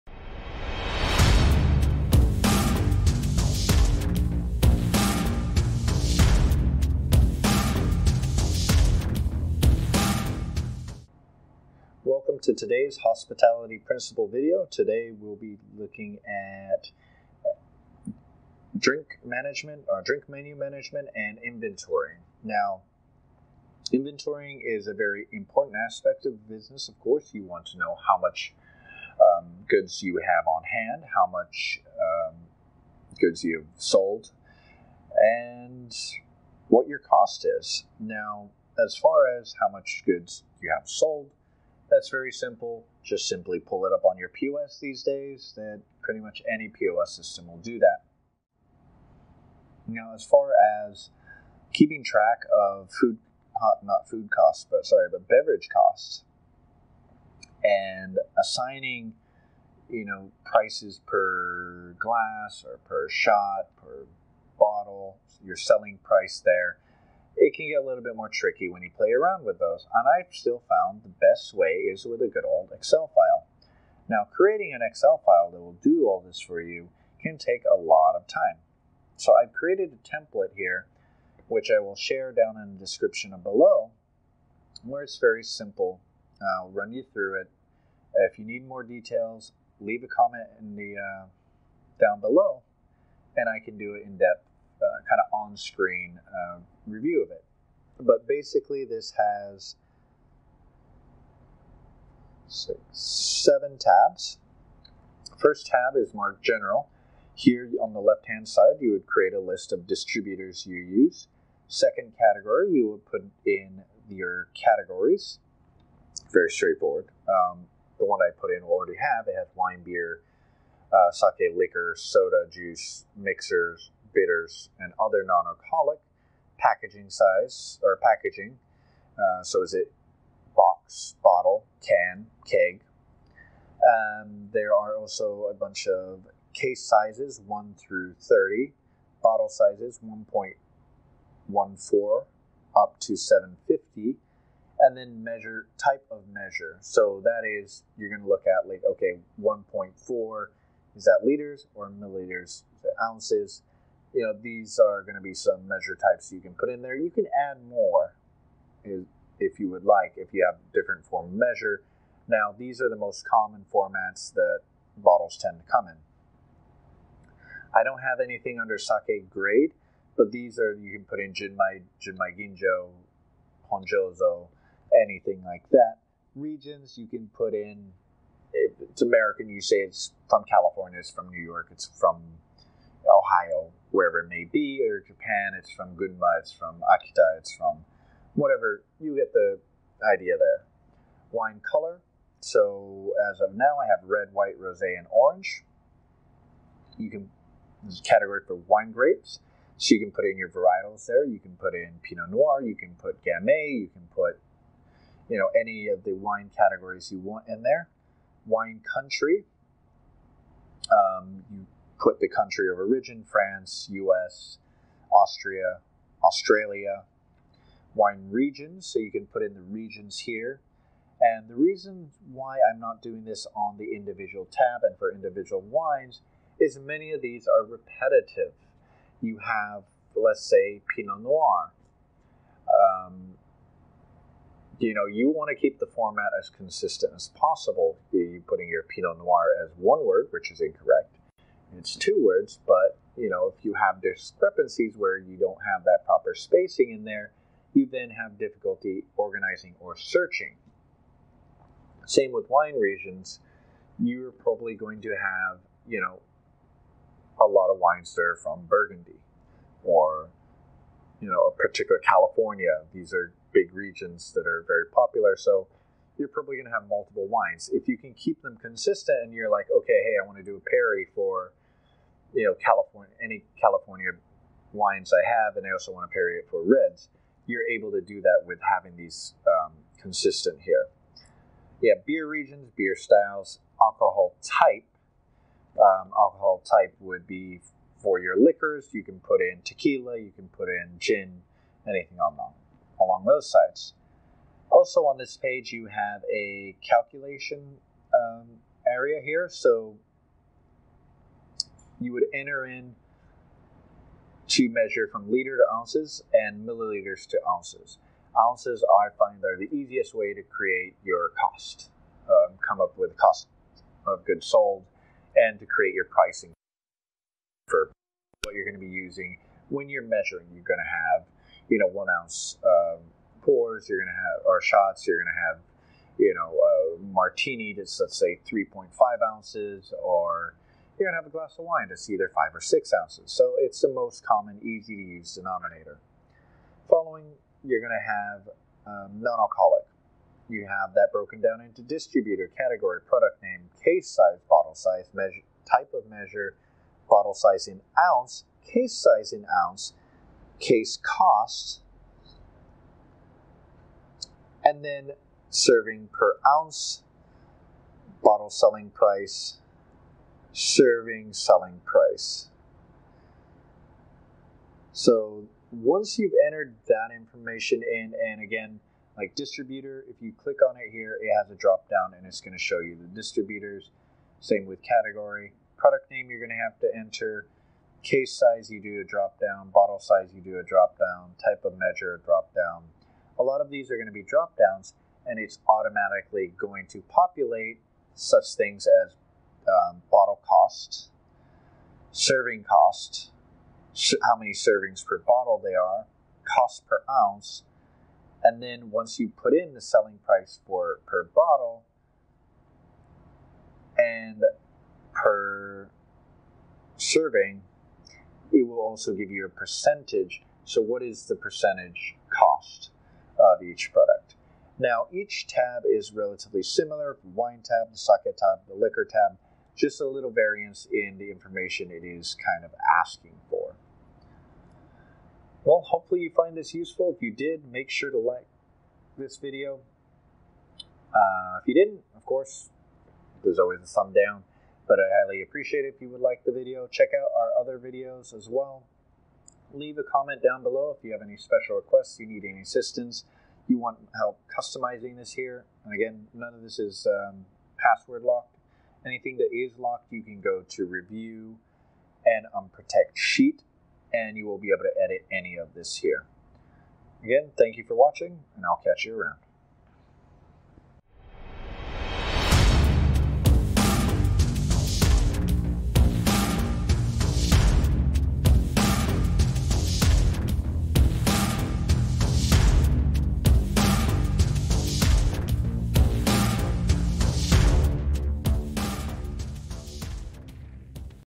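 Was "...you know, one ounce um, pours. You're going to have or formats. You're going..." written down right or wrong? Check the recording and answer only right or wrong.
wrong.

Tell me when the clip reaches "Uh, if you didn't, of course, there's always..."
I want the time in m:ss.
7:11.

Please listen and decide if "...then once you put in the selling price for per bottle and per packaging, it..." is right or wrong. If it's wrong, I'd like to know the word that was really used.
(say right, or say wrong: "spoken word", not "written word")
wrong: "serving", not "packaging".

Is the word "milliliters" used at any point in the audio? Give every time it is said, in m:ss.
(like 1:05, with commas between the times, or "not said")
2:31, 5:06.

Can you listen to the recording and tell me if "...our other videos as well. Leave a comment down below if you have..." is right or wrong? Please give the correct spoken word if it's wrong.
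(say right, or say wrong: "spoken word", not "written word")
right.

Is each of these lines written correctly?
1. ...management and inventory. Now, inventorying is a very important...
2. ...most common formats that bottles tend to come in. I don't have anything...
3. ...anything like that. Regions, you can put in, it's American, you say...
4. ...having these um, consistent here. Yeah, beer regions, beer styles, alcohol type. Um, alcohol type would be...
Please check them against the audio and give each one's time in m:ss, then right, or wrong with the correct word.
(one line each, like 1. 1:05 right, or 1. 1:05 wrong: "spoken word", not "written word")
1. 0:20 right
2. 2:42 right
3. 2:55 right
4. 4:38 right.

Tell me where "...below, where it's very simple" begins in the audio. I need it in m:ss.
1:23.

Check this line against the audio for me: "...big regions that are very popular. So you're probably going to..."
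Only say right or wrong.
right.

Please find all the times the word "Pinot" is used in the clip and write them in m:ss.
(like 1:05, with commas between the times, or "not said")
3:22, 3:50, 3:58.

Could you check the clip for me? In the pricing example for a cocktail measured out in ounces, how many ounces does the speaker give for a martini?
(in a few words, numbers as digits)
3.5 ounces.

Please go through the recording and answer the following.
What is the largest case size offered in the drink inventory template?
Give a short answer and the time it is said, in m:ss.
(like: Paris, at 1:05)
30, at 2:18.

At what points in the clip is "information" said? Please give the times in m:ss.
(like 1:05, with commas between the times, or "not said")
6:07, 7:01.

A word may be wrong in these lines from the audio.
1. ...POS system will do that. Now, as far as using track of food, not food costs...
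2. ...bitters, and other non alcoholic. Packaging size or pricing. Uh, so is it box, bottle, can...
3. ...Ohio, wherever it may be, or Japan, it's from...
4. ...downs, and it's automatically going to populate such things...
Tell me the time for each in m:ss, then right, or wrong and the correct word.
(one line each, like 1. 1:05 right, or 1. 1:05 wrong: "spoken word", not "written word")
1. 0:46 wrong: "keeping", not "using"
2. 2:04 wrong: "packaging", not "pricing"
3. 3:03 right
4. 6:24 right.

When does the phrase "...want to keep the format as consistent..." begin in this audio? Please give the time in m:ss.
3:55.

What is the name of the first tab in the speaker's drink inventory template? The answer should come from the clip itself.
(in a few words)
General.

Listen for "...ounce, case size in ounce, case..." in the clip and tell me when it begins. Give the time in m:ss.
5:47.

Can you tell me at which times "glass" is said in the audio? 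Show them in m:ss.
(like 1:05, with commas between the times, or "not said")
1:01, 5:31.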